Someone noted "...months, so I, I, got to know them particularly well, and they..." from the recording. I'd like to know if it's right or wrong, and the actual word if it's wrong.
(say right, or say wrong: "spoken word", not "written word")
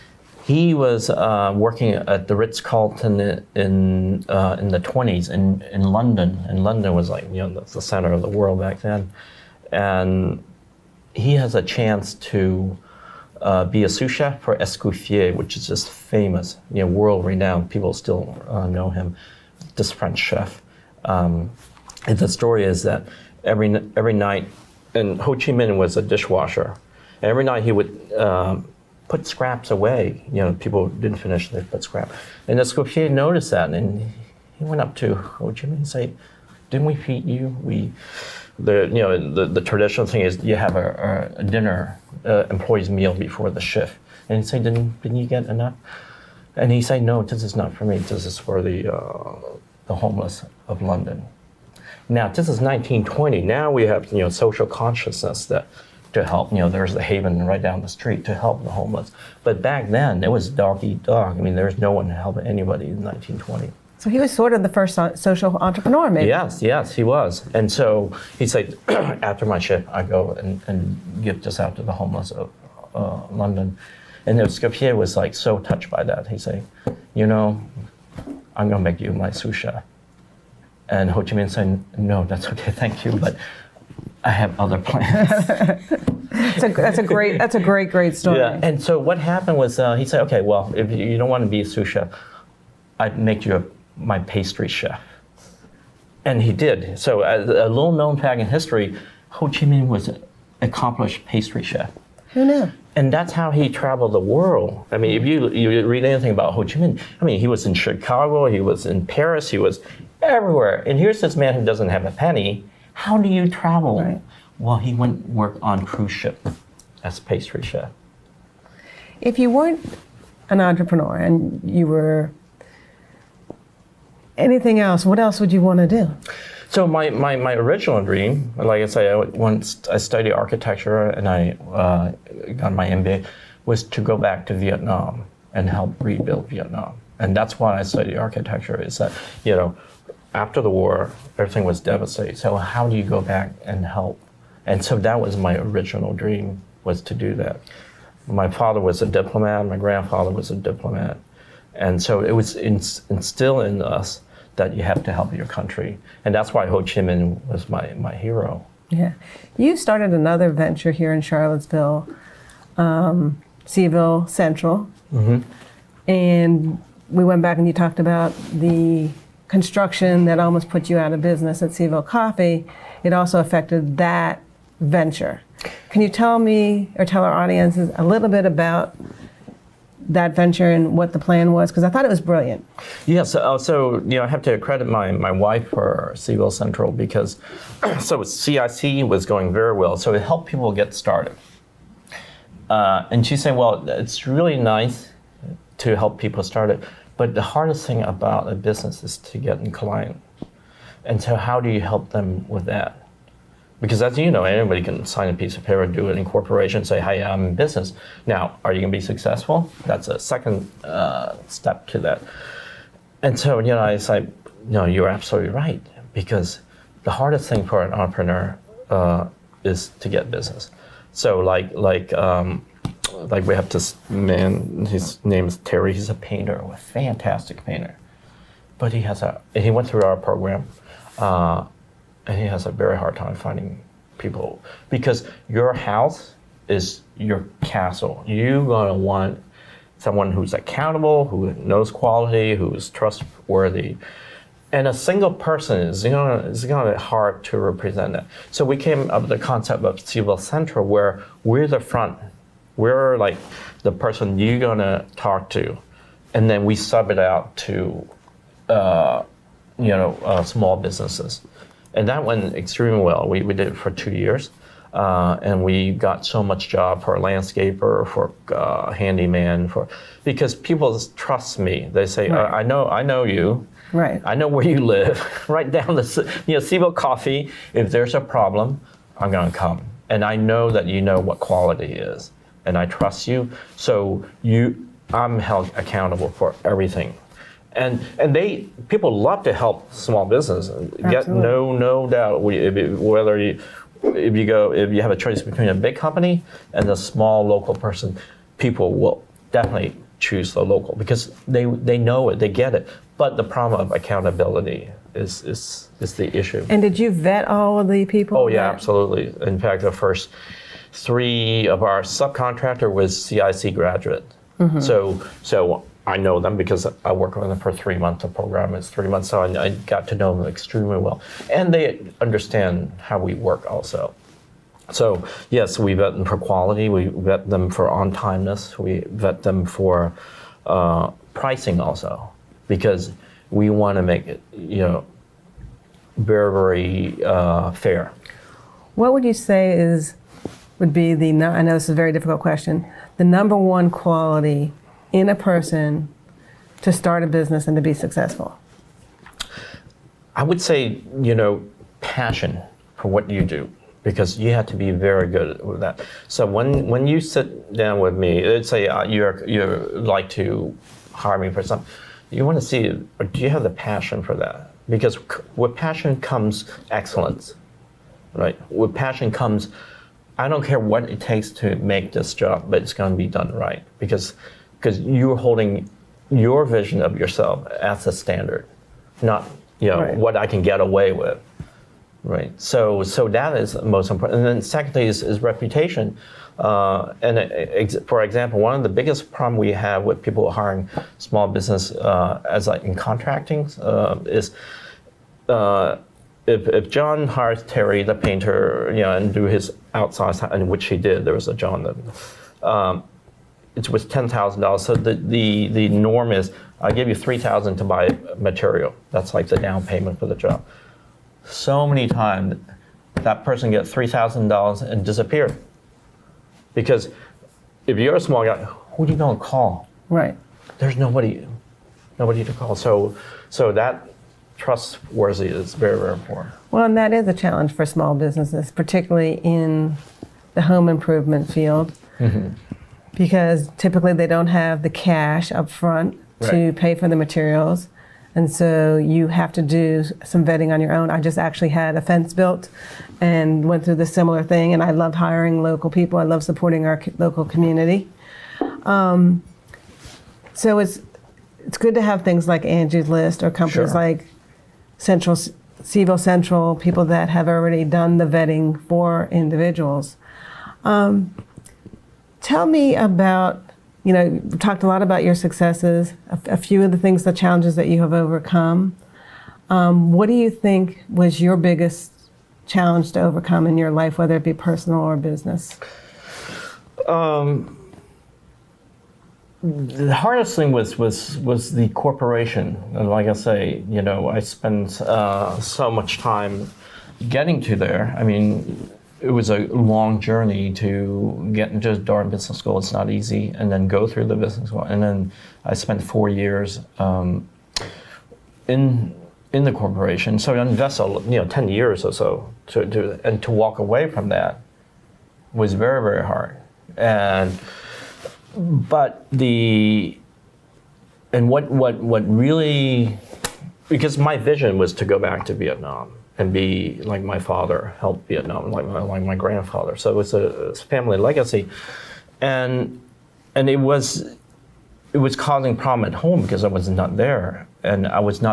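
wrong: "extremely", not "particularly".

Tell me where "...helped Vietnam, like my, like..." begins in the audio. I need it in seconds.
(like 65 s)
517 s.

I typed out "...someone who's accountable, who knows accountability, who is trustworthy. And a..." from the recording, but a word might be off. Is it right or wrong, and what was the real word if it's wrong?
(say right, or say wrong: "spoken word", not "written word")
wrong: "quality", not "accountability".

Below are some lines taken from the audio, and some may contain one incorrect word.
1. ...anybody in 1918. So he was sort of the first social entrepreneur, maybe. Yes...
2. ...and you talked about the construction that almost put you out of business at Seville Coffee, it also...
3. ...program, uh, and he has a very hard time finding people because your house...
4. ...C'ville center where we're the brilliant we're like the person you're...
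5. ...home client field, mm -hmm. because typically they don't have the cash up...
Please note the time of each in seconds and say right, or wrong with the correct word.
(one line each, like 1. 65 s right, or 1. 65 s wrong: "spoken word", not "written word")
1. 62 s wrong: "1920", not "1918"
2. 167 s right
3. 230 s right
4. 249 s wrong: "front", not "brilliant"
5. 430 s wrong: "improvement", not "client".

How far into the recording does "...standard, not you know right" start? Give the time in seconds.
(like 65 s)
378 s.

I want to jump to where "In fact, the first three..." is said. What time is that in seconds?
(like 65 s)
309 s.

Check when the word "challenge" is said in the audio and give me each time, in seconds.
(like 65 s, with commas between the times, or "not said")
427 s, 467 s, 472 s.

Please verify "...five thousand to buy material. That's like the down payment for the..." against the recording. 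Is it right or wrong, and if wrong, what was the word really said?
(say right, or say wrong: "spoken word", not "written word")
wrong: "three", not "five".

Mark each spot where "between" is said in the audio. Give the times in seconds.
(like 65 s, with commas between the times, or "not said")
295 s.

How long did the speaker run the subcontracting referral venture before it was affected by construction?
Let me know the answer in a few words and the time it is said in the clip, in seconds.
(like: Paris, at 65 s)
2 years, at 263 s.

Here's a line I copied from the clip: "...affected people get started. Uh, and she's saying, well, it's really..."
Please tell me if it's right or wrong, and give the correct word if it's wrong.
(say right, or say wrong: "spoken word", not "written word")
wrong: "helped", not "affected".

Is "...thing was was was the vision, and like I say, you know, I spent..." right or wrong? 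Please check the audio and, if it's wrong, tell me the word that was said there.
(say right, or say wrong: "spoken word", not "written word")
wrong: "corporation", not "vision".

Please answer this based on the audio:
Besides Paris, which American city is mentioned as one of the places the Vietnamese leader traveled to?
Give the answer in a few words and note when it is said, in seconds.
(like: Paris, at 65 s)
Chicago, at 107 s.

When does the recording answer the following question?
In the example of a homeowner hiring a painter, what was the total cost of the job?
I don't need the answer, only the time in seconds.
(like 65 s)
404 s.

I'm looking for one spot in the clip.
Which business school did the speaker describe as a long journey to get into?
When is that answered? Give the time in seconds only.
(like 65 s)
491 s.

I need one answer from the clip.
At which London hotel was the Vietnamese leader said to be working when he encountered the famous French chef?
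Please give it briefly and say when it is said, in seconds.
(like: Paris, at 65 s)
Ritz Carlton, at 2 s.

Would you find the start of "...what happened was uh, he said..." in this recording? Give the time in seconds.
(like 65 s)
88 s.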